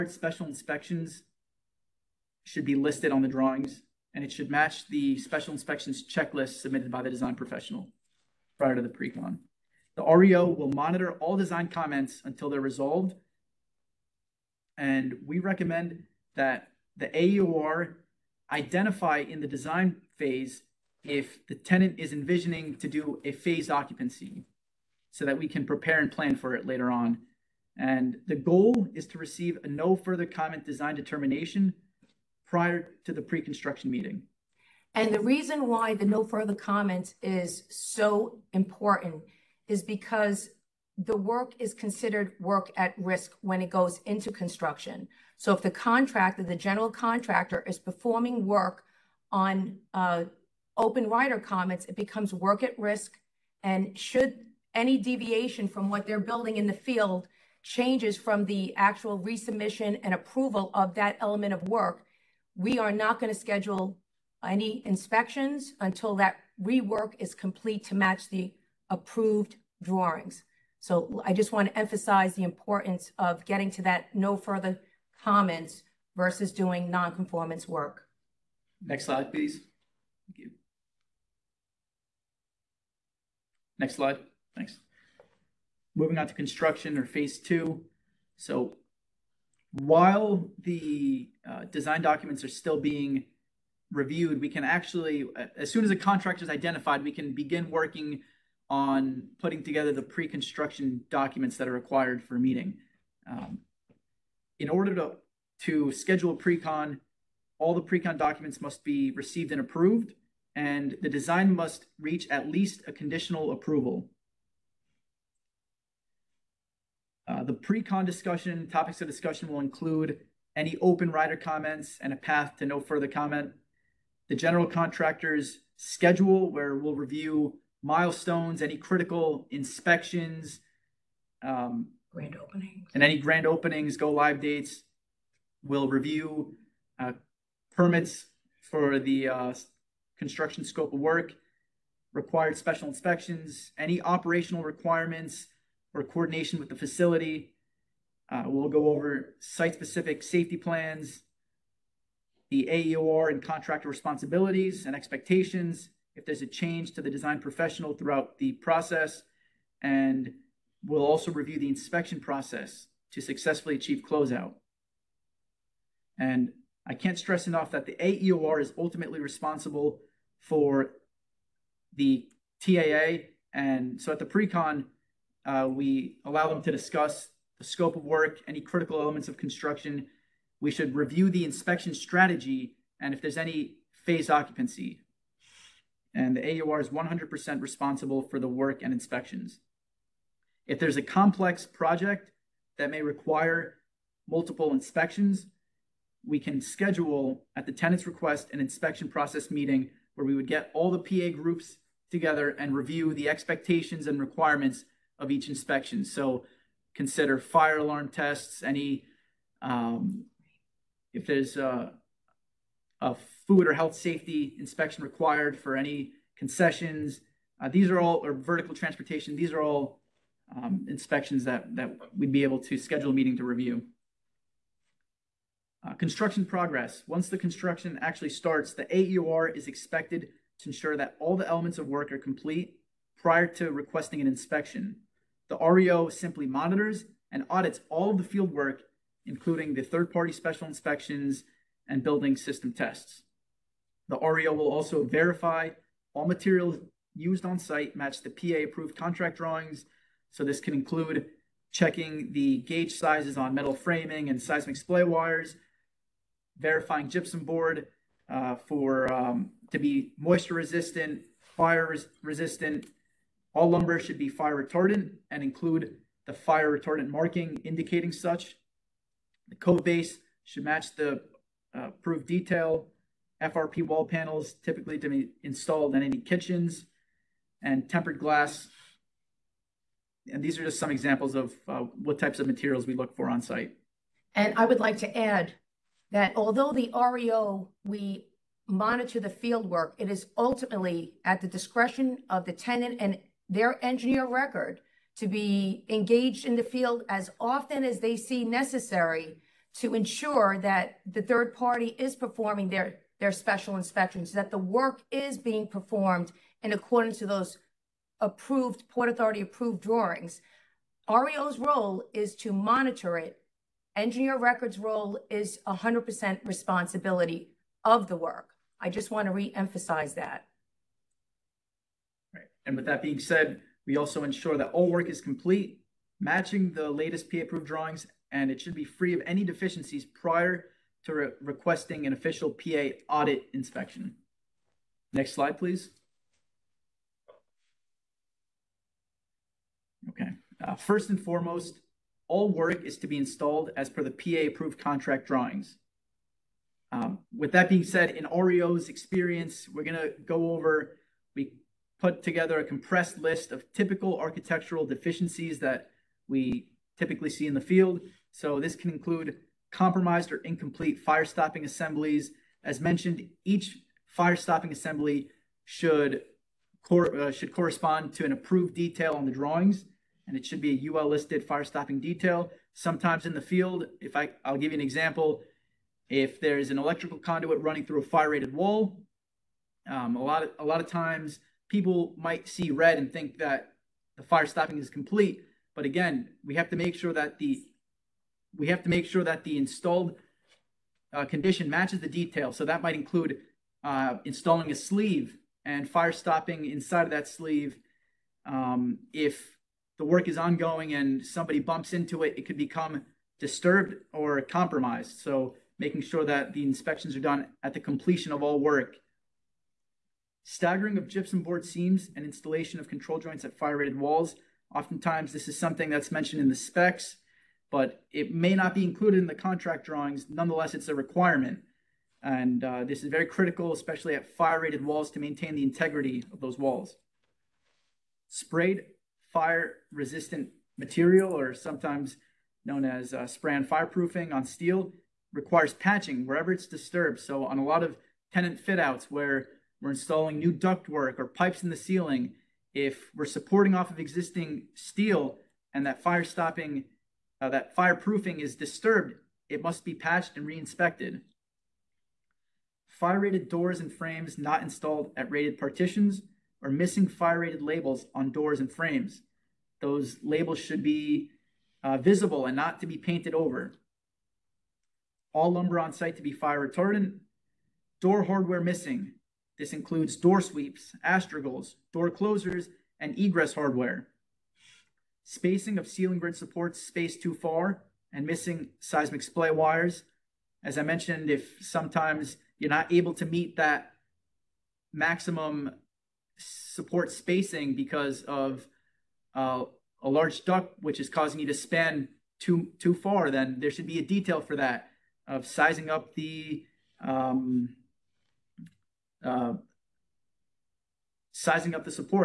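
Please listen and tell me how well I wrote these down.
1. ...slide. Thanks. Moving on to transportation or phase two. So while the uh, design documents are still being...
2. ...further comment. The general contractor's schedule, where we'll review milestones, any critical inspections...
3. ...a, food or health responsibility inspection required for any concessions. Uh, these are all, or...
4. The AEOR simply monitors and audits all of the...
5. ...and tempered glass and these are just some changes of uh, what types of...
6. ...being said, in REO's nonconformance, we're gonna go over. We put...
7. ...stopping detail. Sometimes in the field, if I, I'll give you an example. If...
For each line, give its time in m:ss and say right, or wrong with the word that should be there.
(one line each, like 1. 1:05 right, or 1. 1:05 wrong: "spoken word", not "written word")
1. 1:23 wrong: "construction", not "transportation"
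2. 2:02 right
3. 3:32 wrong: "safety", not "responsibility"
4. 3:55 wrong: "REO", not "AEOR"
5. 4:37 wrong: "examples", not "changes"
6. 5:47 wrong: "experience", not "nonconformance"
7. 6:11 right.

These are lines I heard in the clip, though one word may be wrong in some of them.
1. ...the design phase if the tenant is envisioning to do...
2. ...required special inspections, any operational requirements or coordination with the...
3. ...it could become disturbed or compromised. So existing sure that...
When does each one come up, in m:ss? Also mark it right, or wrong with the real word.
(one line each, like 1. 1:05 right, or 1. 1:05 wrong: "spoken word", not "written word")
1. 0:19 right
2. 2:22 right
3. 6:42 wrong: "making", not "existing".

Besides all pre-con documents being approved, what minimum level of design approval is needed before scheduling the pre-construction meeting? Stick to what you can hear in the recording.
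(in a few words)
Conditional approval.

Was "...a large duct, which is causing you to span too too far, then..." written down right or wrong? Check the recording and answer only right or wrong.
right.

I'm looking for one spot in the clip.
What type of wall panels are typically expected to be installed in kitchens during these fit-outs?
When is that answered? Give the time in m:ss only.
4:33.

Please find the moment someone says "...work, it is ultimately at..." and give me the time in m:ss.
4:49.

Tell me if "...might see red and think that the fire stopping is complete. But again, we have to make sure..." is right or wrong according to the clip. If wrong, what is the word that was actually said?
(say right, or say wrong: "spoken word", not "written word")
right.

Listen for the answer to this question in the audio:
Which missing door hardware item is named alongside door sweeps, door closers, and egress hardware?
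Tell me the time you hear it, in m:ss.
7:51.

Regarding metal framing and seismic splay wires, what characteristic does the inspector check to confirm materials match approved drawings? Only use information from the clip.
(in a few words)
Gauge sizes.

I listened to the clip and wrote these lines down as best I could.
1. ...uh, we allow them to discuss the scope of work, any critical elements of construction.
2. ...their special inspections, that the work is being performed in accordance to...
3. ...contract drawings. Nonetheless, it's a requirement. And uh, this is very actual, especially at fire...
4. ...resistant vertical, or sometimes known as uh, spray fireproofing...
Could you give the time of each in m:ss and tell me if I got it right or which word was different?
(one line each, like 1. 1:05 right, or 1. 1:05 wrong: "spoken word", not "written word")
1. 2:55 right
2. 5:03 right
3. 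6:59 wrong: "critical", not "actual"
4. 7:09 wrong: "material", not "vertical".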